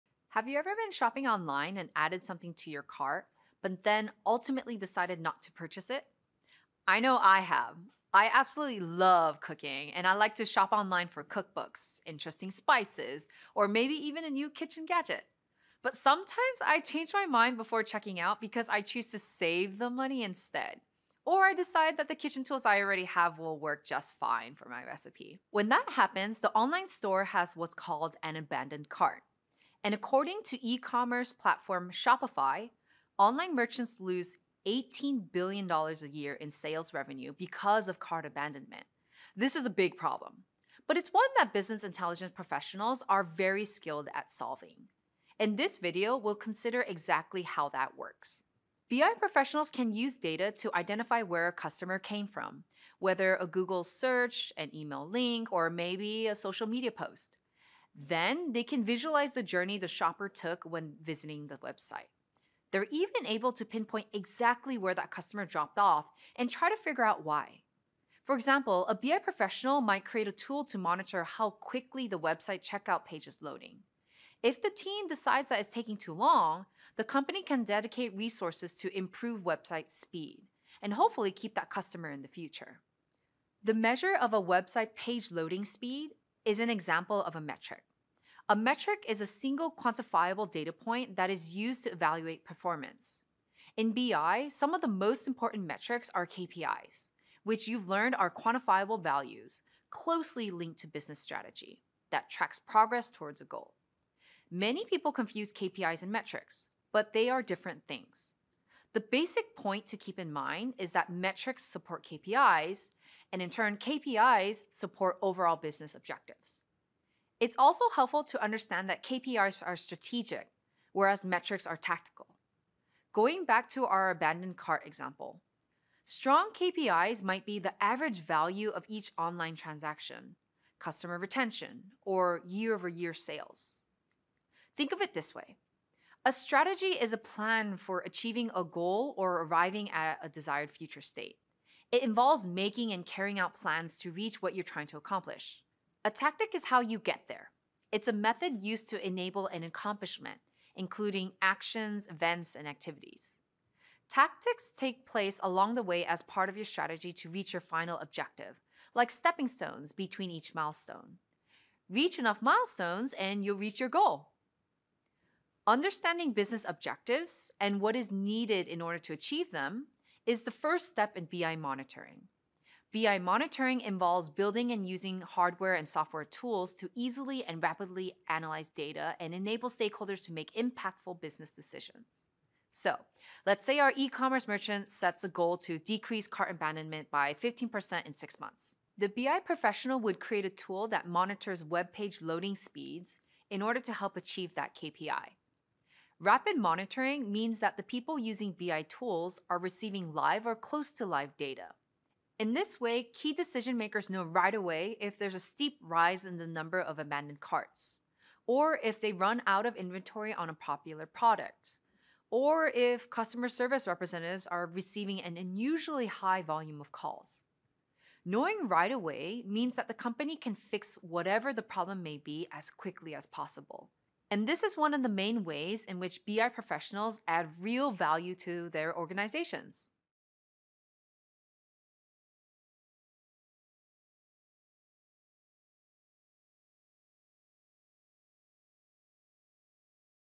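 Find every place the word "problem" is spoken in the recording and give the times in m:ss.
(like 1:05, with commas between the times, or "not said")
0:39, 3:41.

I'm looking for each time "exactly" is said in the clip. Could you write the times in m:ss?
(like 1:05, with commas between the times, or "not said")
0:46, 1:04.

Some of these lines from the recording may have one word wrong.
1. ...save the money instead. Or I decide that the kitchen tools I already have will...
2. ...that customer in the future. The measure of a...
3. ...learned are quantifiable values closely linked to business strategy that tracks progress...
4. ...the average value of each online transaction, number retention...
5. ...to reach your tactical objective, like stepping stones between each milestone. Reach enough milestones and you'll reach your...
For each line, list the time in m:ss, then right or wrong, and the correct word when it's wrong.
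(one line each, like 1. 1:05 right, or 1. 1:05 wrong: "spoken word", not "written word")
1. 0:19 right
2. 1:21 right
3. 1:37 right
4. 2:07 wrong: "customer", not "number"
5. 2:37 wrong: "final", not "tactical".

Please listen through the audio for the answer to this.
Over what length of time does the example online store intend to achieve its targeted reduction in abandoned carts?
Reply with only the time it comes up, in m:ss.
3:08.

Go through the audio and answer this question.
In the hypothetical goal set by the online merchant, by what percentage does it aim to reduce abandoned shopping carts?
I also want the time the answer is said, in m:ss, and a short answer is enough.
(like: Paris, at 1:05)
15%, at 3:07.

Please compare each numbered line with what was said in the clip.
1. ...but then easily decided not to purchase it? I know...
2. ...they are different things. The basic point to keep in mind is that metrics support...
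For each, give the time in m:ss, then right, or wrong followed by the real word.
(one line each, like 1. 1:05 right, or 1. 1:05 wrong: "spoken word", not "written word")
1. 0:03 wrong: "ultimately", not "easily"
2. 1:47 right.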